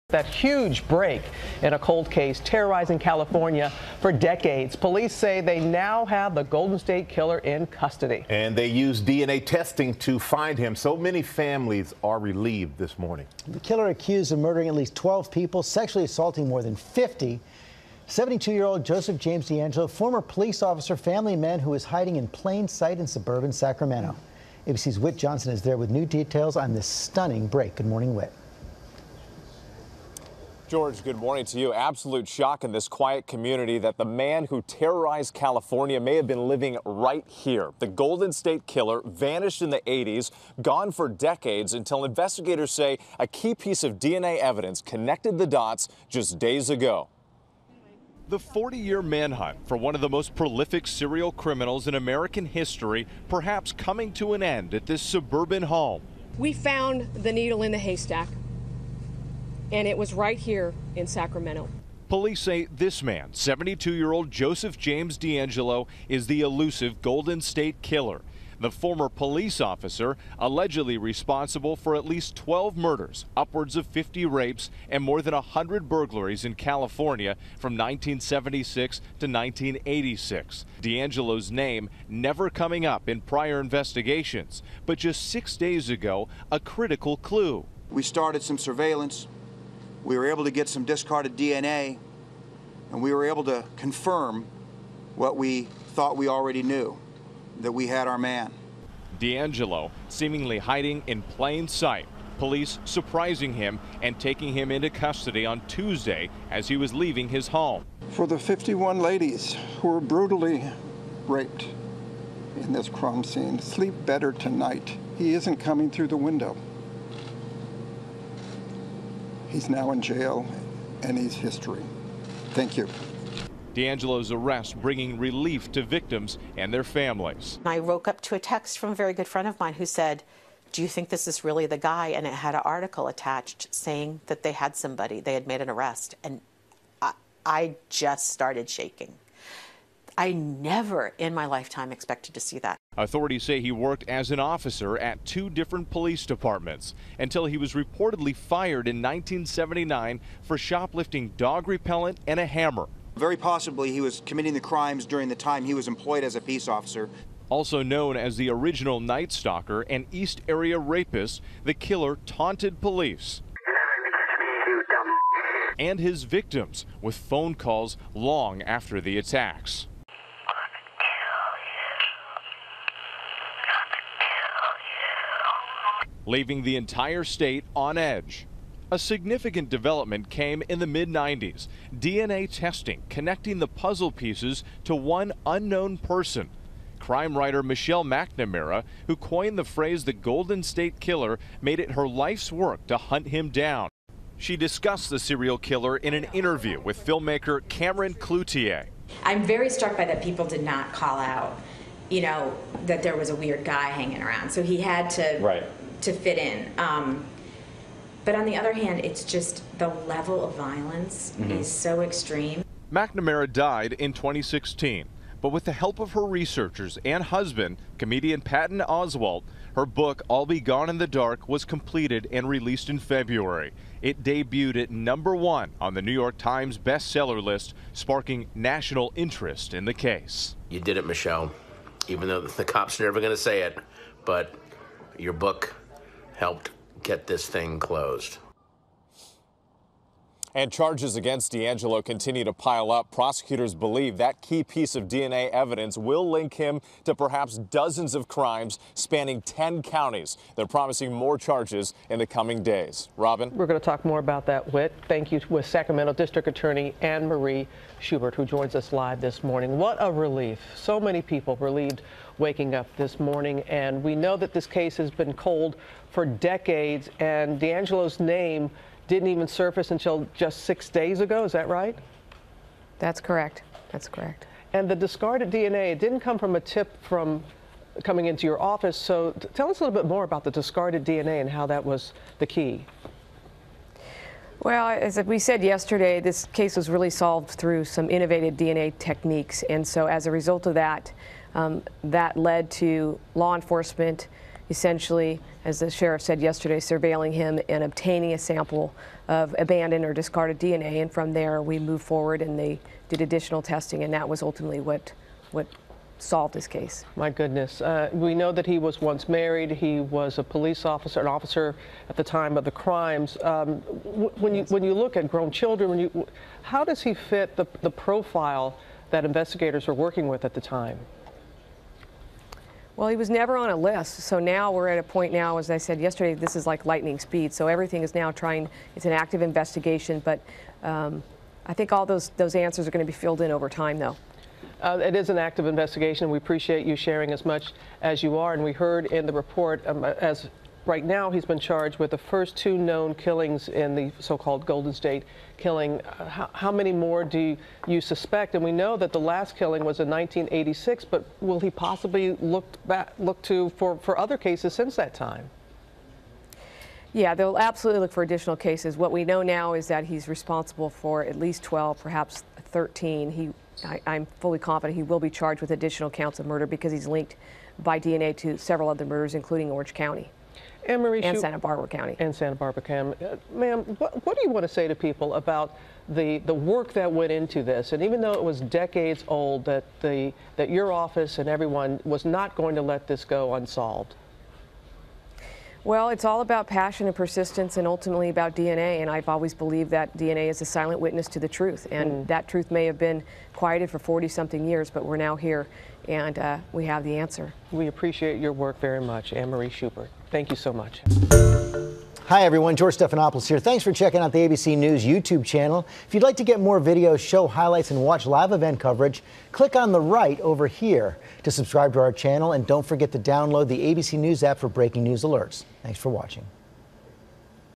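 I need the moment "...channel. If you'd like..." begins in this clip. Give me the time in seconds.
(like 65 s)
405 s.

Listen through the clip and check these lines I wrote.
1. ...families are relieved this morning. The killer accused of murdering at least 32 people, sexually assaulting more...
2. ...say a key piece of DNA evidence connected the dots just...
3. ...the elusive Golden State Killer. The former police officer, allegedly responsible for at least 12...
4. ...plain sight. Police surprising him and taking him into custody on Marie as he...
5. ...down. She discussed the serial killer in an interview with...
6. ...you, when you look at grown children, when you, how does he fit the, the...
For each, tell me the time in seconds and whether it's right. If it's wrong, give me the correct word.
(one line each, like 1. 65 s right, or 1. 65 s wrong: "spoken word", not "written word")
1. 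11 s wrong: "12", not "32"
2. 42 s right
3. 66 s right
4. 101 s wrong: "Tuesday", not "Marie"
5. 193 s right
6. 314 s right.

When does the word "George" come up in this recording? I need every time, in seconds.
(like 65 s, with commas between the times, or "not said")
30 s, 402 s.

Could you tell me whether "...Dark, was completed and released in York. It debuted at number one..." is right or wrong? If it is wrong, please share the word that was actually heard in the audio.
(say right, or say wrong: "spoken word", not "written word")
wrong: "February", not "York".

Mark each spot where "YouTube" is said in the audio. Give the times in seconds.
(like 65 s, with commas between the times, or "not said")
405 s.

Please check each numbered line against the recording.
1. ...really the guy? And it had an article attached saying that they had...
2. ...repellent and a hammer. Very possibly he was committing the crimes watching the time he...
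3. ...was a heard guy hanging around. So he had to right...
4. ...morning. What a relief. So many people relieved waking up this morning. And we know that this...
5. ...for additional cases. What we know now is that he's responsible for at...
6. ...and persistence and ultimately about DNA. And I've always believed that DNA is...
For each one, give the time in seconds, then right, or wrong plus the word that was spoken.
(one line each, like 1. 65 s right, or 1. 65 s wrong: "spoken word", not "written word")
1. 131 s right
2. 151 s wrong: "during", not "watching"
3. 203 s wrong: "weird", not "heard"
4. 259 s right
5. 358 s right
6. 387 s right.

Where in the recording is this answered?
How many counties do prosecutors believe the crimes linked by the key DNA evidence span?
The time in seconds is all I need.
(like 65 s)
249 s.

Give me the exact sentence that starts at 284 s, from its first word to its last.
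Well, as we said yesterday, this case was really solved through some innovative DNA techniques.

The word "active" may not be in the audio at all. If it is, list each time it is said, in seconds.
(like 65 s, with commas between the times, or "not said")
329 s, 335 s.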